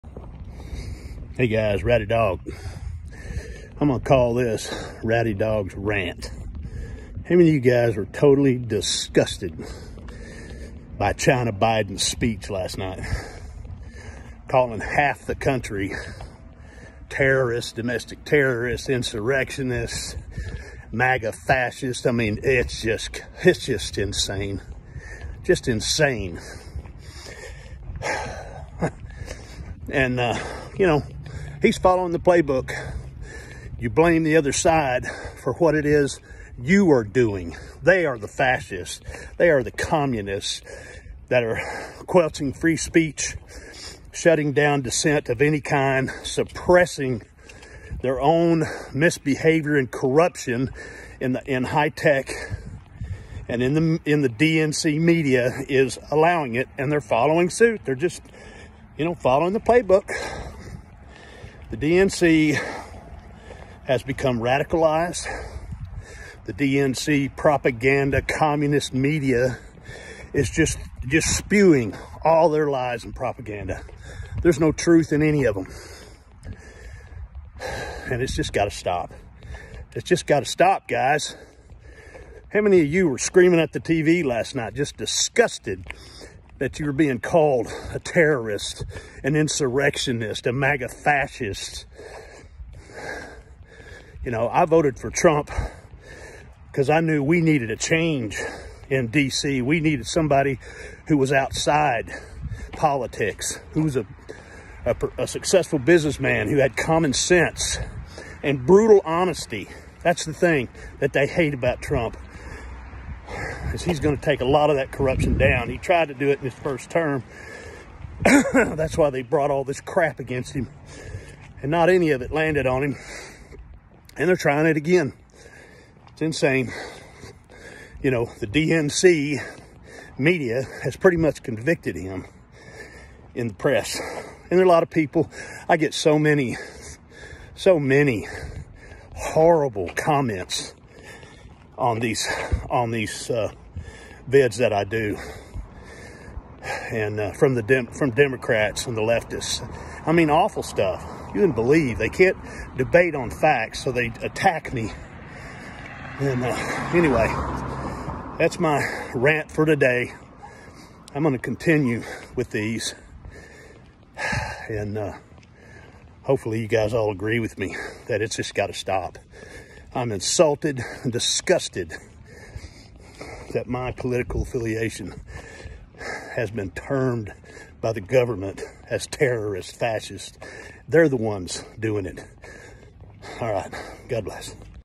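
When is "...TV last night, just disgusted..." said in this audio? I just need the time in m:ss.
1:23.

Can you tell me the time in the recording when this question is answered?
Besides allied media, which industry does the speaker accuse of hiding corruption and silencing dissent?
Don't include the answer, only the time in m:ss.
0:51.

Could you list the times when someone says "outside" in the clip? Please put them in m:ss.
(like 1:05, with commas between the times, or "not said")
1:41.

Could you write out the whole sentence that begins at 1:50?
That's the thing that they hate about Trump is he's going to take a lot of that corruption down.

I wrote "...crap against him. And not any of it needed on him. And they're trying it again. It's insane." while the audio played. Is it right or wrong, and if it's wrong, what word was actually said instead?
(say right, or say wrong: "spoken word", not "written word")
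wrong: "landed", not "needed".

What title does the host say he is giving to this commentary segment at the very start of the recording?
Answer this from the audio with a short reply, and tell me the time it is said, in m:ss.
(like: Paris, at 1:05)
RowdyDawg's Rant, at 0:05.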